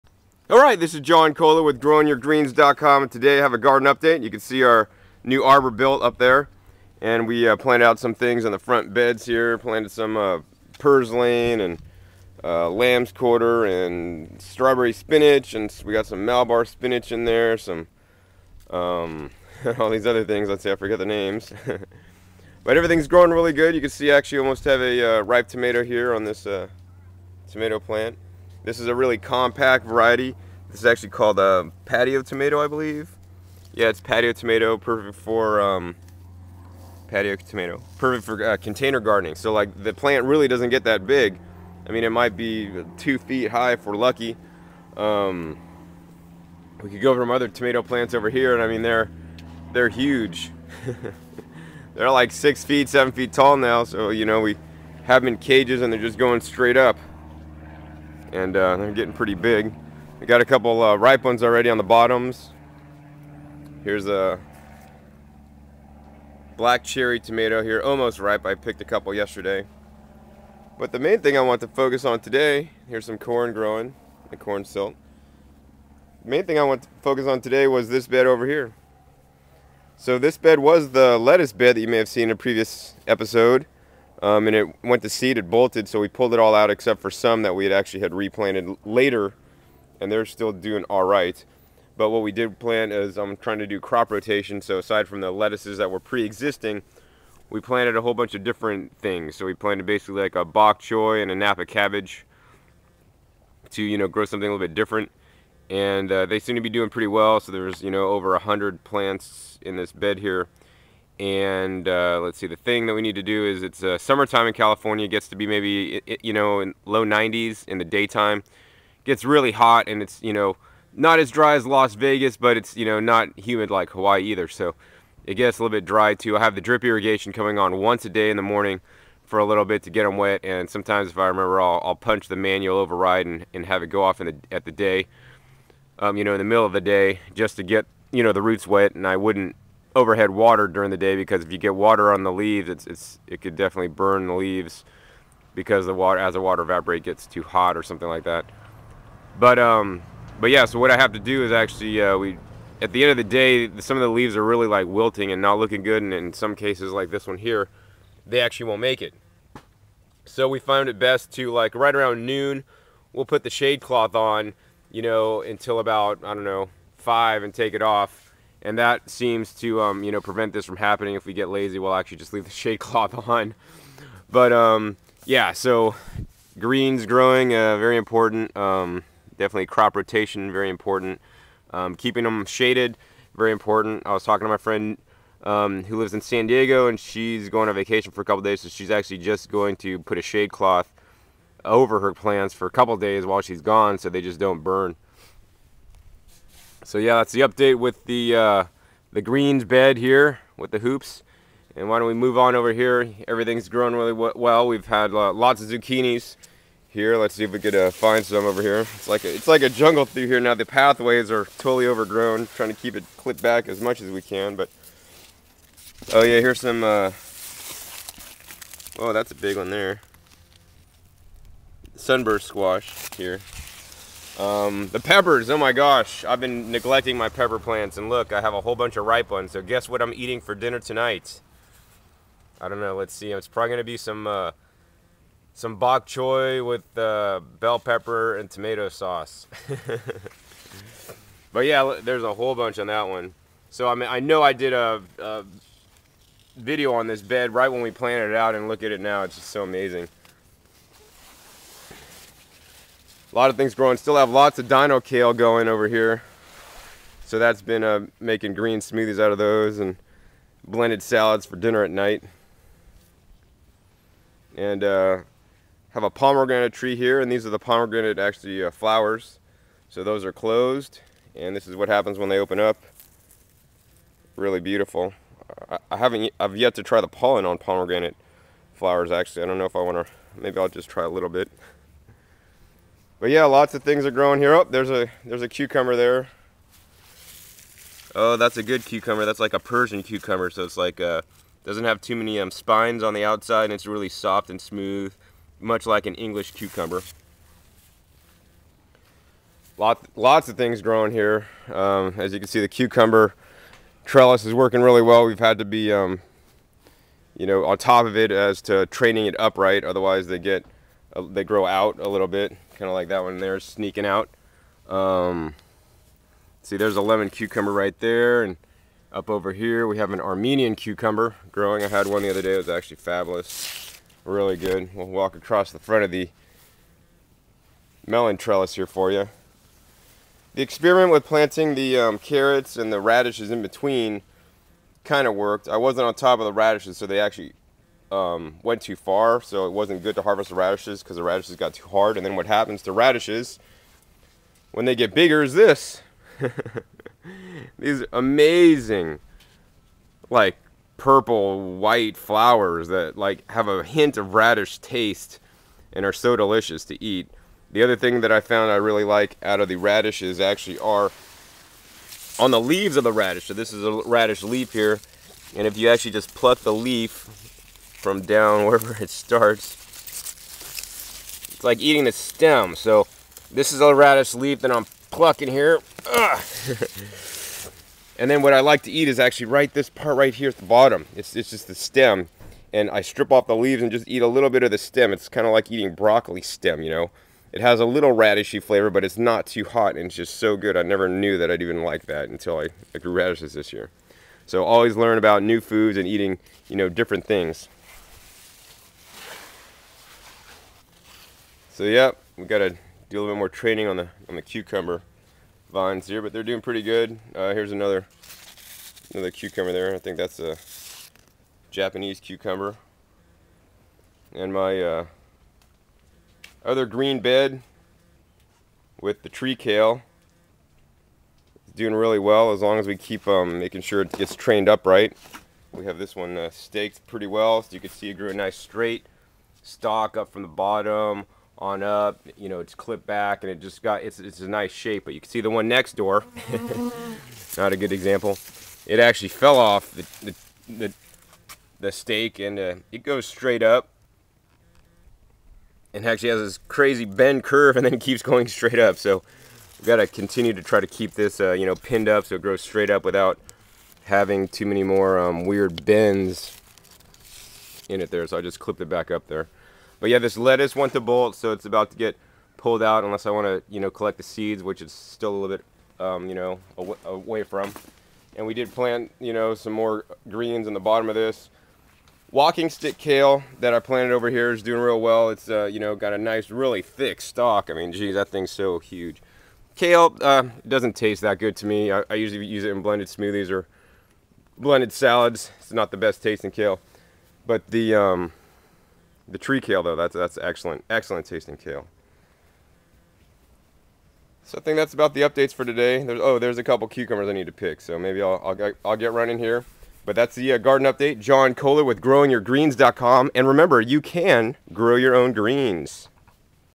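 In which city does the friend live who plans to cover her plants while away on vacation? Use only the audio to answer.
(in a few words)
San Diego.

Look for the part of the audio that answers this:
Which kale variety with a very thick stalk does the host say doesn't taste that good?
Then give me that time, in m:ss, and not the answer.
7:52.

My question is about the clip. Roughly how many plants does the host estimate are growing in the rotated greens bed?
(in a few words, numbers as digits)
over 100.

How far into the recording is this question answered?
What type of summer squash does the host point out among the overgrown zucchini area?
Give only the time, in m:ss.
3:41.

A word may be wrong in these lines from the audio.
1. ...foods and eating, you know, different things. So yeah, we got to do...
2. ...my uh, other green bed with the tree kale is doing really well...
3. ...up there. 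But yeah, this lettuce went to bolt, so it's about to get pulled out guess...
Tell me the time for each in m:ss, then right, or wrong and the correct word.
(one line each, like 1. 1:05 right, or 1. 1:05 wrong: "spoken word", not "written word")
1. 6:35 right
2. 6:54 right
3. 7:39 wrong: "unless", not "guess".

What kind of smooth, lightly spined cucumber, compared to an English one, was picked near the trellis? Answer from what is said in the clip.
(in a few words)
Persian cucumber.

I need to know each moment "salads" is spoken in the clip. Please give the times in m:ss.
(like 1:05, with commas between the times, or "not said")
4:21, 8:04.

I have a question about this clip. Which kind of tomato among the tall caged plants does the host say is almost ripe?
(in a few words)
black cherry.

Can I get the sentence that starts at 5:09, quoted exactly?
Otherwise, they get, uh, they grow out a little bit kind of like that one there sneaking out.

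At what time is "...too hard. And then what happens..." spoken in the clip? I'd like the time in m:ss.
5:41.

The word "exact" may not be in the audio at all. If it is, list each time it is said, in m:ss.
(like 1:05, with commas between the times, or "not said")
not said.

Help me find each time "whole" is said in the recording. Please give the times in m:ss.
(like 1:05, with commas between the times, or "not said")
1:38, 3:48, 4:02.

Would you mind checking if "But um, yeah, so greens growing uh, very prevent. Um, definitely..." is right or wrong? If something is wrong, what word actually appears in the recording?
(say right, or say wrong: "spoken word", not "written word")
wrong: "important", not "prevent".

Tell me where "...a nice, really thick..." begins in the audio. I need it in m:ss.
7:56.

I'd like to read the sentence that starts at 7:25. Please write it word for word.
And actually has this crazy bend curve, and then it keeps going straight up.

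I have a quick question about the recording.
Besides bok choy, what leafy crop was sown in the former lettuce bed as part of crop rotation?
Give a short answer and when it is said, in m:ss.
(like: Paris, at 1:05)
Napa cabbage, at 1:41.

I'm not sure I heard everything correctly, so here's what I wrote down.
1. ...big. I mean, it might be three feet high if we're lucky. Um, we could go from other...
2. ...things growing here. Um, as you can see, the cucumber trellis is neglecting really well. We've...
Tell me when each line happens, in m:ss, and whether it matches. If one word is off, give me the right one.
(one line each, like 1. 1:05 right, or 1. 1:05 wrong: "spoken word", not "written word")
1. 0:41 wrong: "two", not "three"
2. 5:00 wrong: "working", not "neglecting".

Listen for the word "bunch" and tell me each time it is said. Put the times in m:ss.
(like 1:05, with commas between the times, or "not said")
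1:38, 3:48, 4:02.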